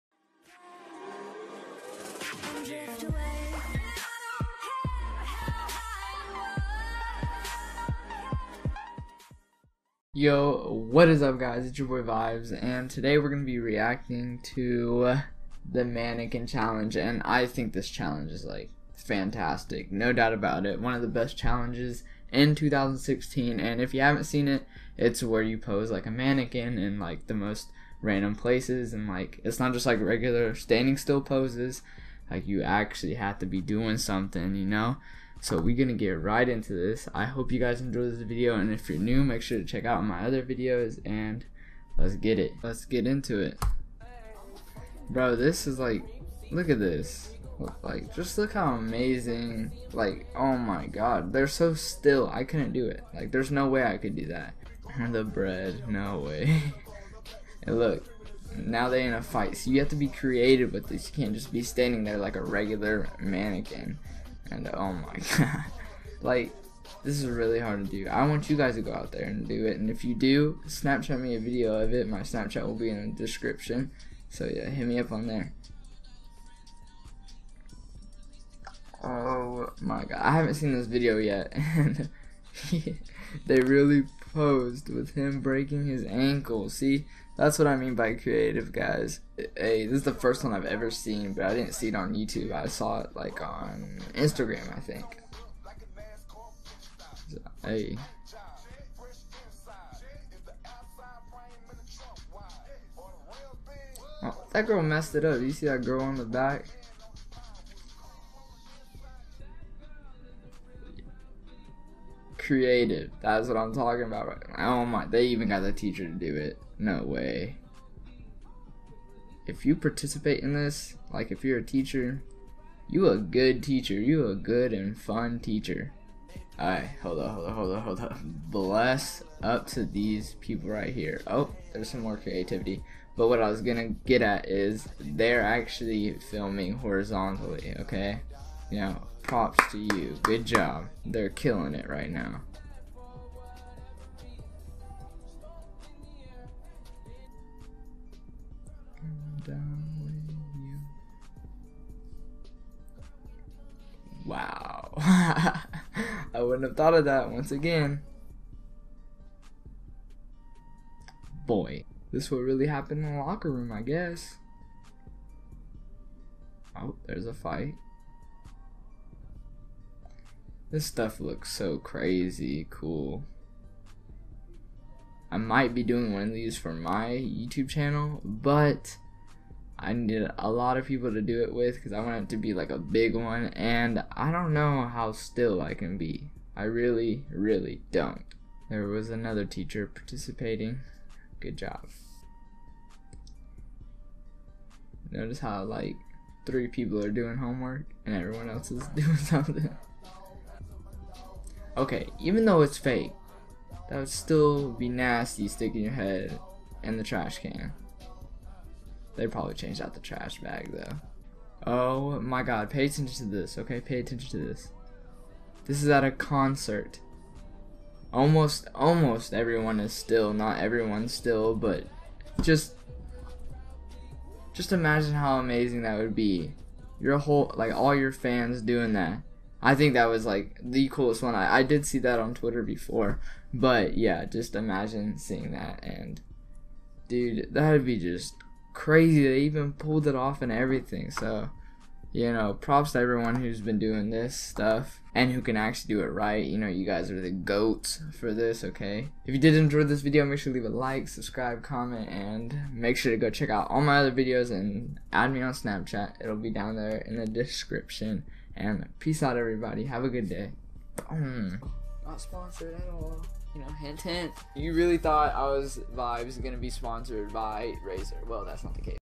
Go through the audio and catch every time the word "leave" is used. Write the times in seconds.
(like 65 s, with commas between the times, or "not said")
250 s.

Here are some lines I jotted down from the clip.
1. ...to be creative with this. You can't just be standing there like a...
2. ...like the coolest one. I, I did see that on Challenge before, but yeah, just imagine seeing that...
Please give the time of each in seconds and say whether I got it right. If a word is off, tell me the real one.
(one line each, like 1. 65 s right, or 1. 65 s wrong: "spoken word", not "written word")
1. 59 s right
2. 230 s wrong: "Twitter", not "Challenge".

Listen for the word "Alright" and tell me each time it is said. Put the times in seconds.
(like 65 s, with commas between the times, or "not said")
126 s.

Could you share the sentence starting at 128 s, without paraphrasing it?
Bless up to these people right here.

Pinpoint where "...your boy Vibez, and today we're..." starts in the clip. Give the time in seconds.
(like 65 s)
11 s.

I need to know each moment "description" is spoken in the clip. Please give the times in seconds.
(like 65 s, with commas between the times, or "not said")
73 s, 257 s.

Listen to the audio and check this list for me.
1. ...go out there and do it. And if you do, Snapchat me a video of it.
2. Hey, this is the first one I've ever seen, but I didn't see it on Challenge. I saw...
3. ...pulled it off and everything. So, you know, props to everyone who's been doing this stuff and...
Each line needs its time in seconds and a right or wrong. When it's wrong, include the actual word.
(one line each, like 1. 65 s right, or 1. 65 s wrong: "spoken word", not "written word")
1. 68 s right
2. 89 s wrong: "YouTube", not "Challenge"
3. 239 s right.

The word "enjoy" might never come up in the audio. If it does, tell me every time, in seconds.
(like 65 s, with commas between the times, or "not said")
37 s, 249 s.